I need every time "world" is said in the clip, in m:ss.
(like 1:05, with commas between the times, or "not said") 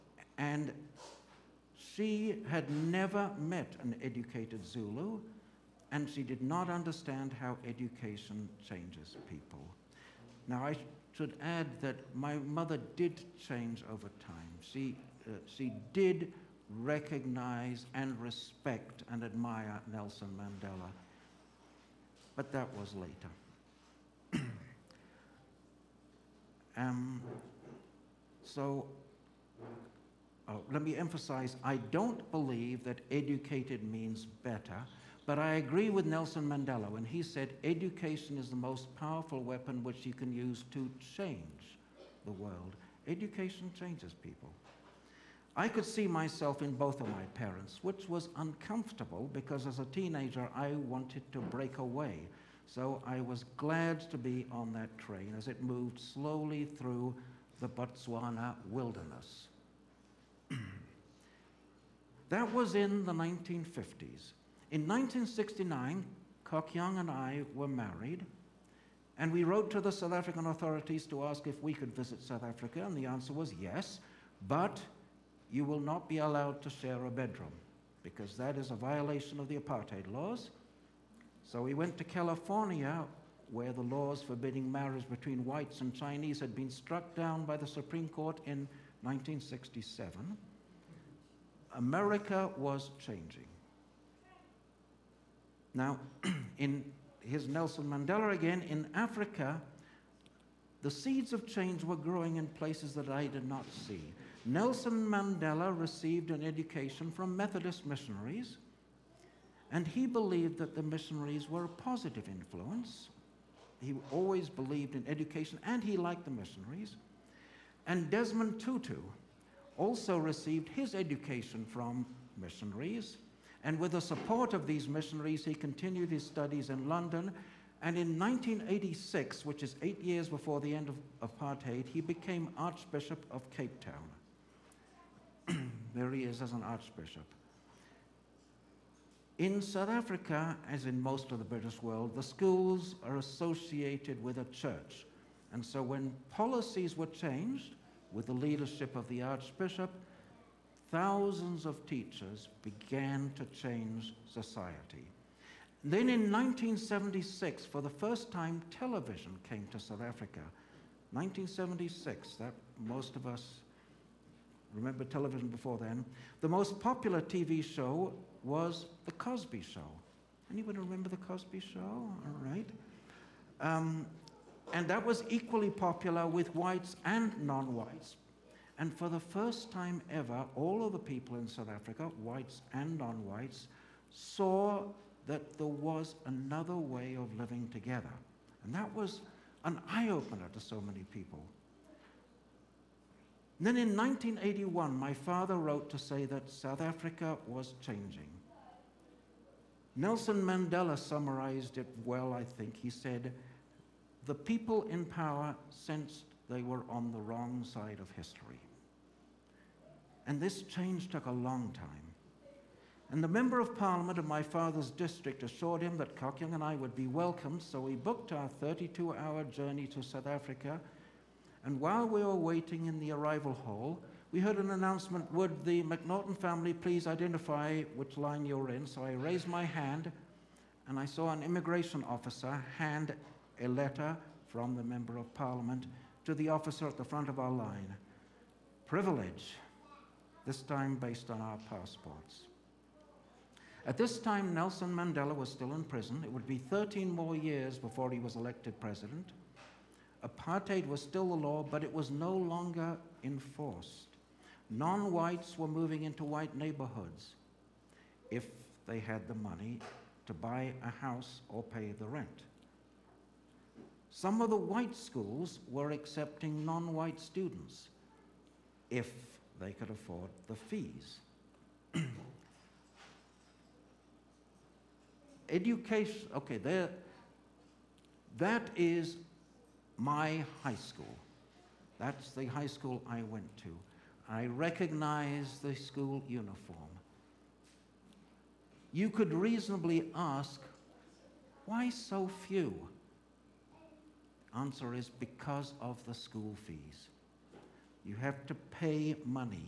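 0:42, 2:21.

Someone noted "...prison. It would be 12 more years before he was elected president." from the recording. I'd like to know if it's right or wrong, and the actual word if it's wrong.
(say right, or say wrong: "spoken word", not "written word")
wrong: "13", not "12".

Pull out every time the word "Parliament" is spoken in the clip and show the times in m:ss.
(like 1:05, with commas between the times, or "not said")
3:33, 3:55.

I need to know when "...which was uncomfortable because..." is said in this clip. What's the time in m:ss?
0:47.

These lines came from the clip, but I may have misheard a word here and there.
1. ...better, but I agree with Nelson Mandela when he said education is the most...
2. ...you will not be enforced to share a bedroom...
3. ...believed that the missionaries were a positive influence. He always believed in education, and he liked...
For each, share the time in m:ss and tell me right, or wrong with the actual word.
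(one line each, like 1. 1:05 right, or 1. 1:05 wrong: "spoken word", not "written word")
1. 0:34 right
2. 1:15 wrong: "allowed", not "enforced"
3. 1:50 right.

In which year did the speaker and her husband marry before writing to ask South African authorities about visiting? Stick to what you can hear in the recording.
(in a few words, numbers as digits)
1969.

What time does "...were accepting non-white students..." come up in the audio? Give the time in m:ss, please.
4:25.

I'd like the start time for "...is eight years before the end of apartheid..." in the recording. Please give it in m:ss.
2:09.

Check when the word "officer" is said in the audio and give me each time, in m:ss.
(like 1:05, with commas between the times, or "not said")
3:52, 3:56.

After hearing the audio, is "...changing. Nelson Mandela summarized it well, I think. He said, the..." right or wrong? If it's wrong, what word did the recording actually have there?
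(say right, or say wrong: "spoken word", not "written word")
right.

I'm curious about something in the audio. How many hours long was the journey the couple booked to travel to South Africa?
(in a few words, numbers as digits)
32.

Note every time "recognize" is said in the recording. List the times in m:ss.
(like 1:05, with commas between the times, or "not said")
0:16, 4:44.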